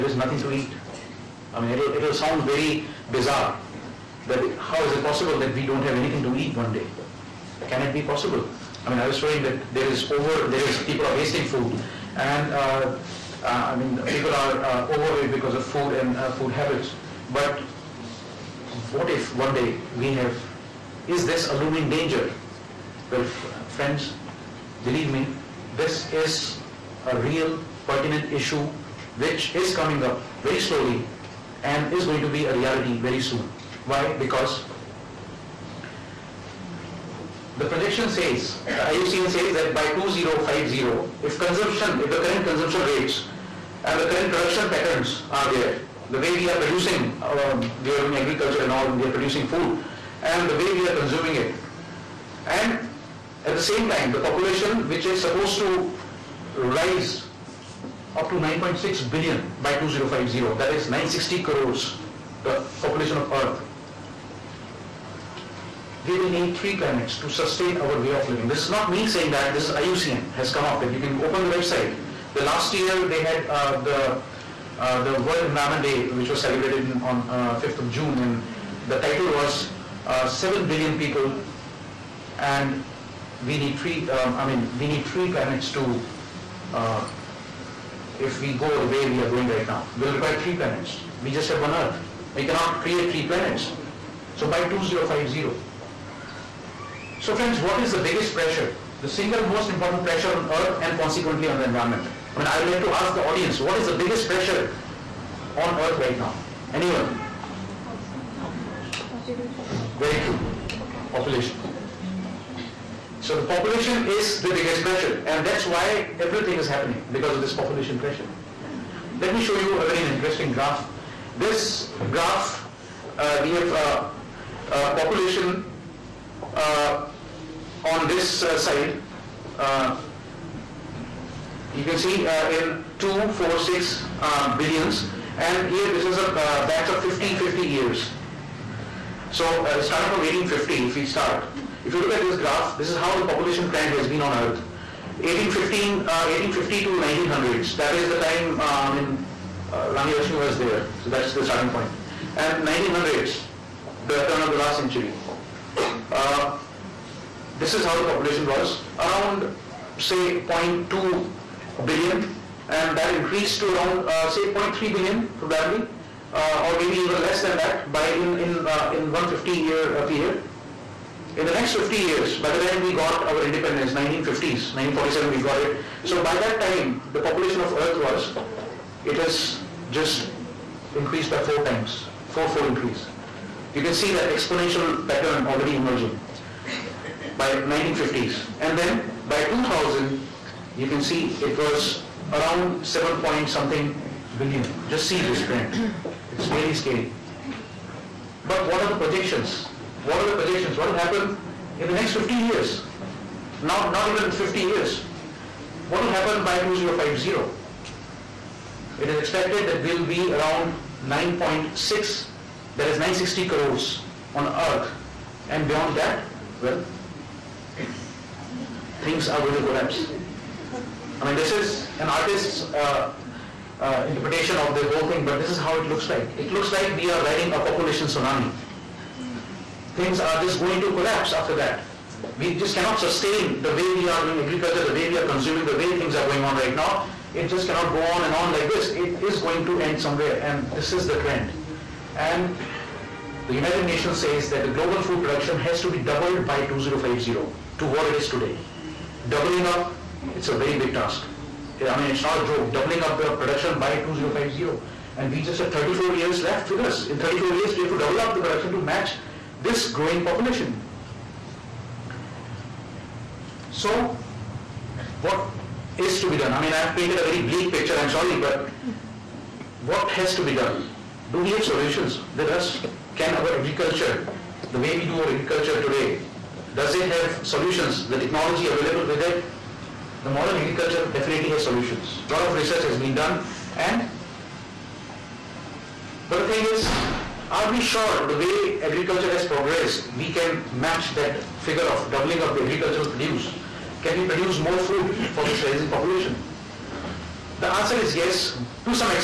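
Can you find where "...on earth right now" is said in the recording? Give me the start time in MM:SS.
01:45.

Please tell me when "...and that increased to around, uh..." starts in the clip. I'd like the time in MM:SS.
02:42.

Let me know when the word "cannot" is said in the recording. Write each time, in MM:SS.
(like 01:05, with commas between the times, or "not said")
01:32, 03:52, 03:57.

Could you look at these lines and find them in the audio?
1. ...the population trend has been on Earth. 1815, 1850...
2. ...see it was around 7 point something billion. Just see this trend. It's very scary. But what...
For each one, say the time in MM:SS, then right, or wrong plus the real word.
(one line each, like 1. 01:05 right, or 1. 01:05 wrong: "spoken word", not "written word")
1. 02:23 right
2. 03:10 right.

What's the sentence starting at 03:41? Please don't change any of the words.
I mean, this is an artist's uh, uh, interpretation of the whole thing, but this is how it looks like.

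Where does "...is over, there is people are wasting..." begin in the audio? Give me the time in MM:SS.
00:09.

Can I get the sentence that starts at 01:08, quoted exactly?
This is not me saying that, this is IUCN has come up with.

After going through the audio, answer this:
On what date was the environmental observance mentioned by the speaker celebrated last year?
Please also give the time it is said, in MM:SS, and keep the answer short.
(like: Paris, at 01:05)
5th of June, at 01:17.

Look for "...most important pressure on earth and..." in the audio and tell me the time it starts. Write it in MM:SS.
01:39.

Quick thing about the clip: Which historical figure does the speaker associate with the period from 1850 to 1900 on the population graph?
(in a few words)
Rani Lakshmi.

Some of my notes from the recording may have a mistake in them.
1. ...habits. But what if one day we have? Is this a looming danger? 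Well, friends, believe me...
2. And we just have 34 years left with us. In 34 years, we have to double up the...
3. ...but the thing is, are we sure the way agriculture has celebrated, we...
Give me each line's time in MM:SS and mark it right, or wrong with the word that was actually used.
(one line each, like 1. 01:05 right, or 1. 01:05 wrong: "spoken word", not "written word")
1. 00:16 right
2. 04:15 right
3. 04:46 wrong: "progressed", not "celebrated".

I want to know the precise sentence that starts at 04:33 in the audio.
Can our agriculture, the way we do our agriculture today, does it have solutions, the technology available with it?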